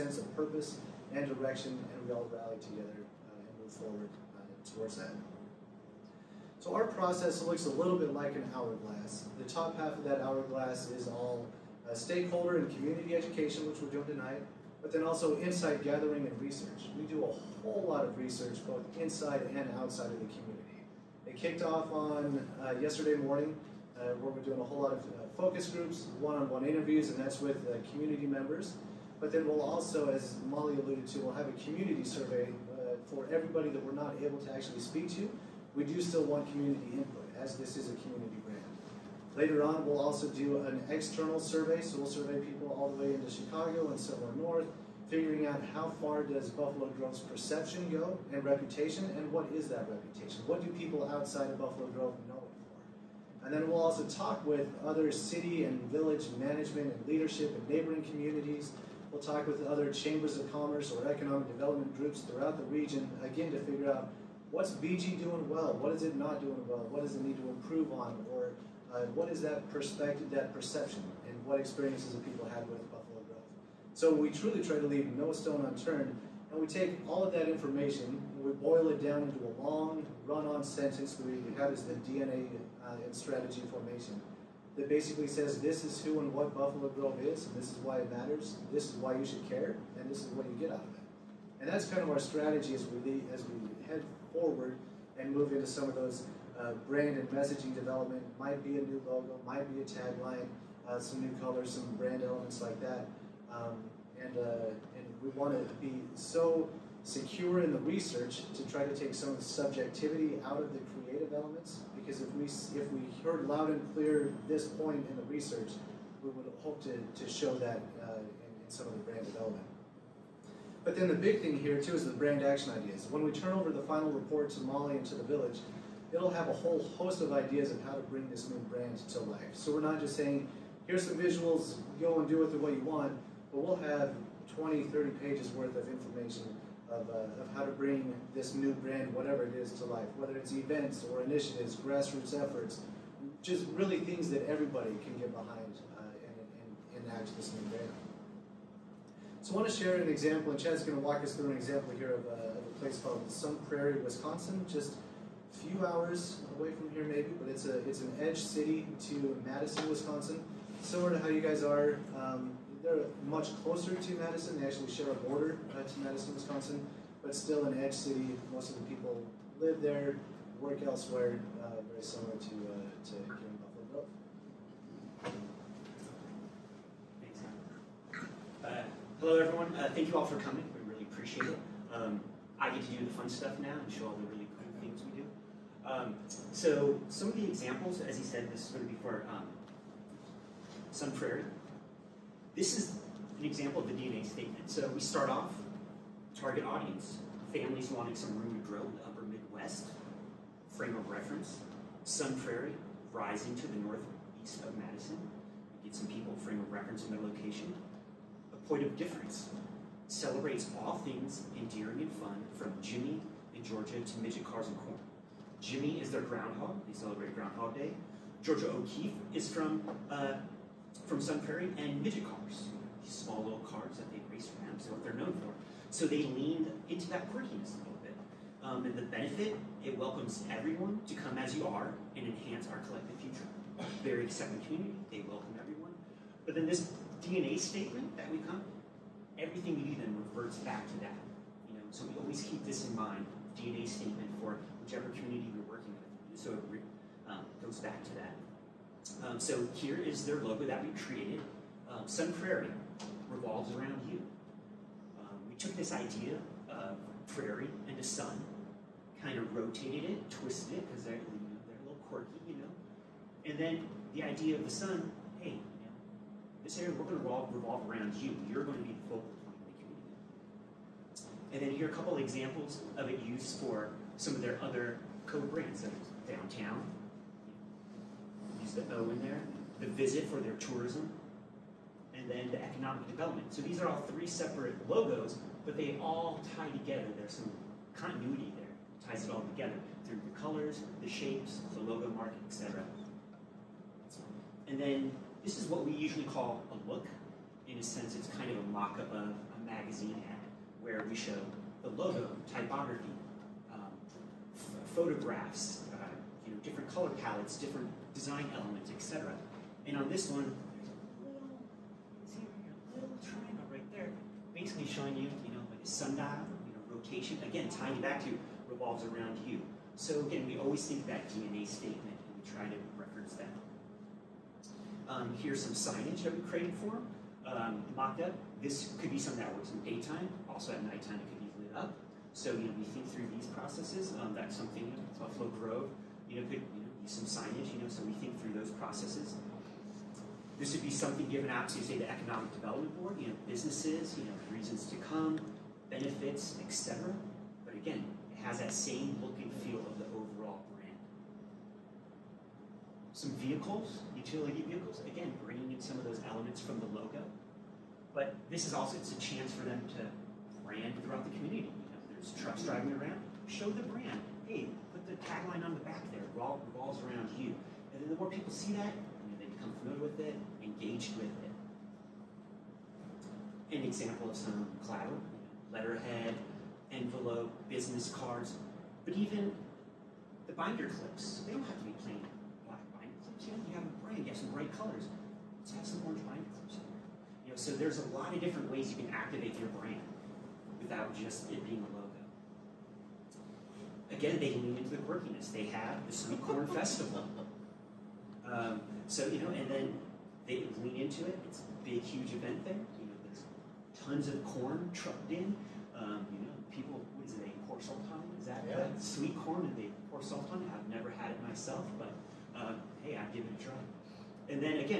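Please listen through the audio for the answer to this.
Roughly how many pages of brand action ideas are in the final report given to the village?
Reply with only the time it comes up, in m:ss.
2:14.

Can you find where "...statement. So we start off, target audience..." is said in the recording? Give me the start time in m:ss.
3:14.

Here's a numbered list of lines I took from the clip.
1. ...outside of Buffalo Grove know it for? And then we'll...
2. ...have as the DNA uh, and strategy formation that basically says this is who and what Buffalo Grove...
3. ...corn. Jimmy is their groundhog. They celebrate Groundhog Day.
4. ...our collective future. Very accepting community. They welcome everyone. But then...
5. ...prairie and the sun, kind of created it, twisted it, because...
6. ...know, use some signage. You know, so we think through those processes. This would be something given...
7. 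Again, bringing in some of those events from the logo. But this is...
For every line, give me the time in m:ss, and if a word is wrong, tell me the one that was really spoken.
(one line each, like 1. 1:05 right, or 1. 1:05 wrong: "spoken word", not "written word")
1. 0:51 right
2. 1:21 right
3. 3:34 right
4. 3:52 right
5. 4:17 wrong: "rotated", not "created"
6. 5:36 right
7. 5:55 wrong: "elements", not "events".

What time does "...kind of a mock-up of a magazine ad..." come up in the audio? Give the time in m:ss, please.
4:58.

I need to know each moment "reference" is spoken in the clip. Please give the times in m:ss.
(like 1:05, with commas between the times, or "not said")
3:21, 3:26, 5:22.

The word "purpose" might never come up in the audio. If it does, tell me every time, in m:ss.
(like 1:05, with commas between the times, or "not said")
0:00.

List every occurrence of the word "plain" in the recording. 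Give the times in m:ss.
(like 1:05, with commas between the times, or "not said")
6:22.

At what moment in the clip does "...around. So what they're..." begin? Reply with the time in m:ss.
3:44.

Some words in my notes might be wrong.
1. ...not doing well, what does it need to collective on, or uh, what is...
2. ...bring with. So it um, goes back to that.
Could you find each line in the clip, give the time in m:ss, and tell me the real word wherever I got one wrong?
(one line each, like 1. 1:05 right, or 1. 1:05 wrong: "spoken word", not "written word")
1. 1:06 wrong: "improve", not "collective"
2. 4:05 wrong: "working", not "bring".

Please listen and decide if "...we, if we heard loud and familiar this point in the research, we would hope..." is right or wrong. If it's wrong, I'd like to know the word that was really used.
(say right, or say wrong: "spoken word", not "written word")
wrong: "clear", not "familiar".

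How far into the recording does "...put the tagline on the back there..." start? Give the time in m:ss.
6:04.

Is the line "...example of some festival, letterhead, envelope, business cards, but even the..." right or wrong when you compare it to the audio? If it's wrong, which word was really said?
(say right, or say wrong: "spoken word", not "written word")
wrong: "collateral", not "festival".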